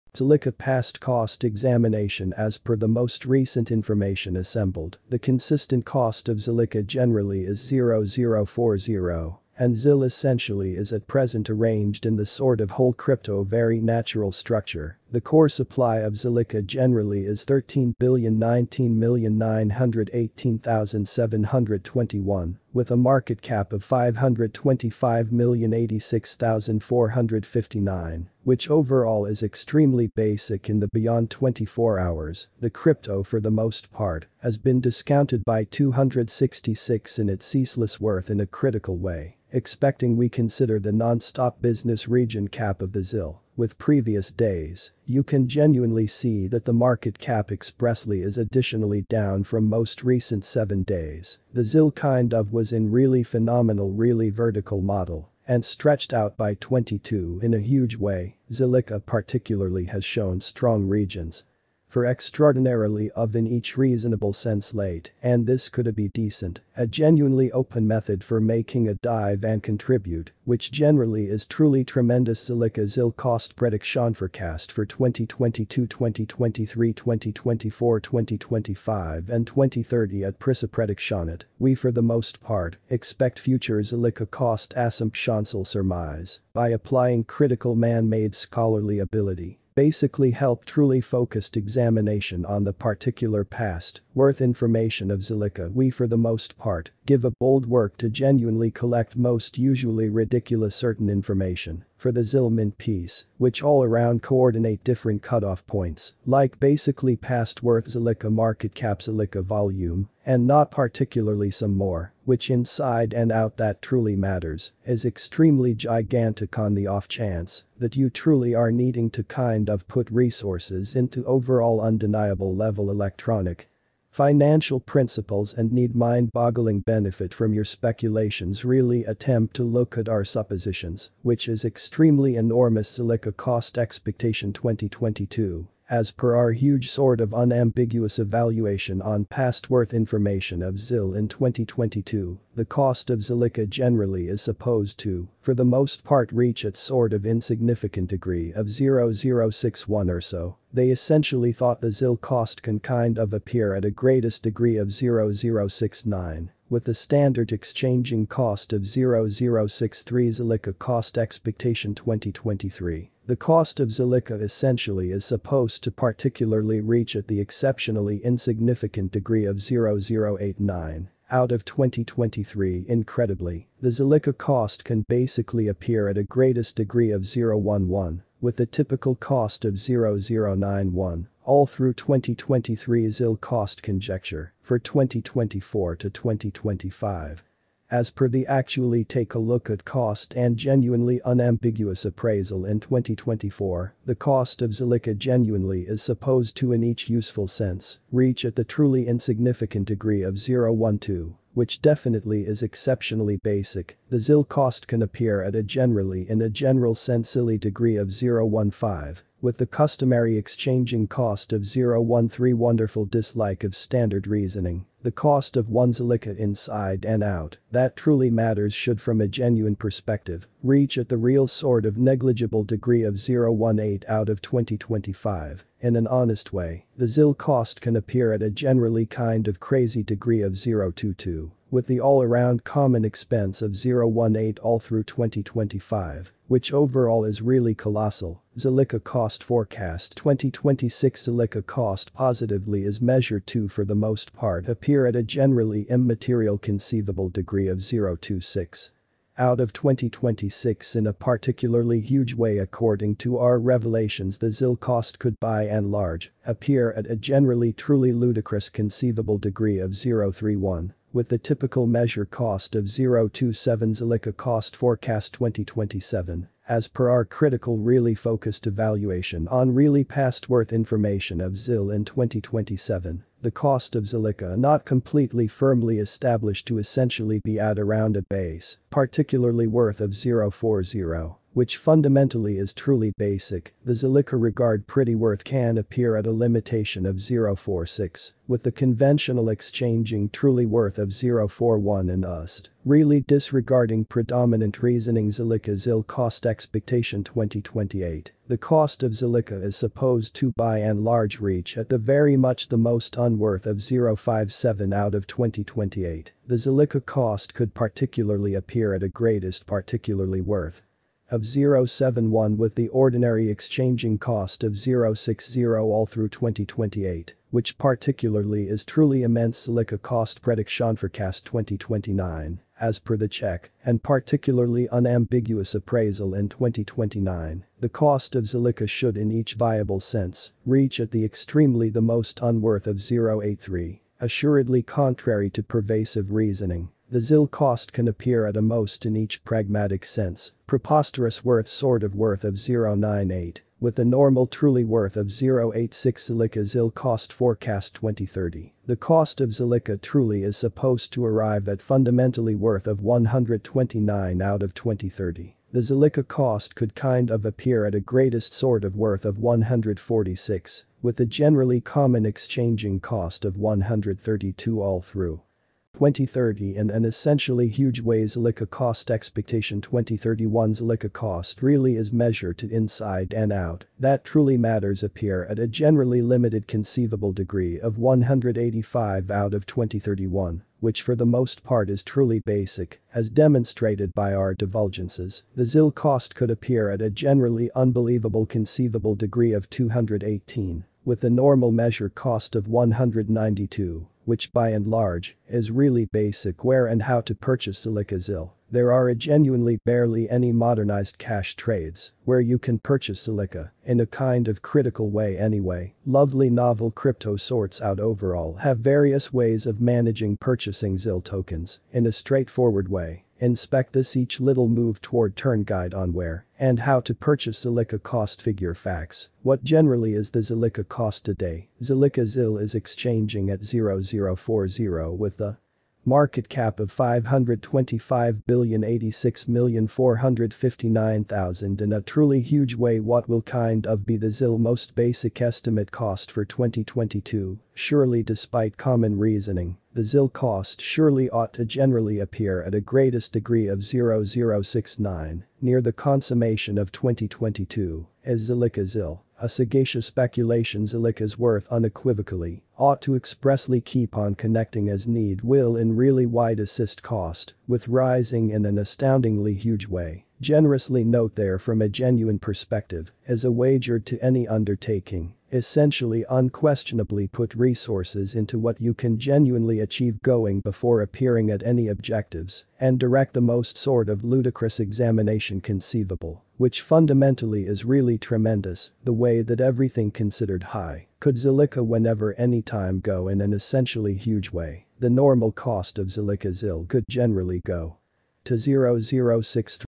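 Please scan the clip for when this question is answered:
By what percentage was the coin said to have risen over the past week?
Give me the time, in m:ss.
0:56.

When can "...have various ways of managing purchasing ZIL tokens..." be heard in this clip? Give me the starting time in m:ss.
6:48.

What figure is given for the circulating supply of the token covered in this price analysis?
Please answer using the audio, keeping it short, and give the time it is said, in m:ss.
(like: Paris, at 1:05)
13,019,918,721, at 0:17.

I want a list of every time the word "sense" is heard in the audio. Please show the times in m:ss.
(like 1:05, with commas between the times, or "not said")
1:04, 3:17, 3:26, 5:30, 5:40.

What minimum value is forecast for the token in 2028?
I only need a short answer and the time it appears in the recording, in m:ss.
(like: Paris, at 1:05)
0.57, at 5:03.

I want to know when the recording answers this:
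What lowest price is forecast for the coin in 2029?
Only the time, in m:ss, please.
5:32.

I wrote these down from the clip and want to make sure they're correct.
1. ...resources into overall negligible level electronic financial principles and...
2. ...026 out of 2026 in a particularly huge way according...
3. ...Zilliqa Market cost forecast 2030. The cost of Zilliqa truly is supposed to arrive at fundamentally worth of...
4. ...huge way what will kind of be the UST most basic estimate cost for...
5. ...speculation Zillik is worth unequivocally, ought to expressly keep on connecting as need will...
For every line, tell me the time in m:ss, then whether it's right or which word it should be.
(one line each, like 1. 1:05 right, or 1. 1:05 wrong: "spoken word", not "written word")
1. 2:00 wrong: "undeniable", not "negligible"
2. 4:07 right
3. 5:46 wrong: "ZIL", not "Market"
4. 7:12 wrong: "ZIL", not "UST"
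5. 7:30 right.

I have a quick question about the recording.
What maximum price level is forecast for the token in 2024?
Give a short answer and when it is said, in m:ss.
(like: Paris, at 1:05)
0.15, at 3:28.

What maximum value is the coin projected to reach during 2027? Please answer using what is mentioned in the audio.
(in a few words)
0.46.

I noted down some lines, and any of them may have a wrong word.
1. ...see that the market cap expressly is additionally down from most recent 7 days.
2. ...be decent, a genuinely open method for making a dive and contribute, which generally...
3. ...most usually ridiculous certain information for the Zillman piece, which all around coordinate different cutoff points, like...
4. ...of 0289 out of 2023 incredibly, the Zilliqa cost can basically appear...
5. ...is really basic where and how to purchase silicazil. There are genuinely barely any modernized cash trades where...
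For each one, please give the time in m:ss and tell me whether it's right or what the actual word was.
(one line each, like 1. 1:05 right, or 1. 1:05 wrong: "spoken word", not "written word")
1. 0:46 right
2. 1:05 right
3. 1:39 right
4. 2:49 wrong: "0089", not "0289"
5. 6:35 right.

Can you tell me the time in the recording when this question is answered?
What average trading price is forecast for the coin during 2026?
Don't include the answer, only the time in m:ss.
4:22.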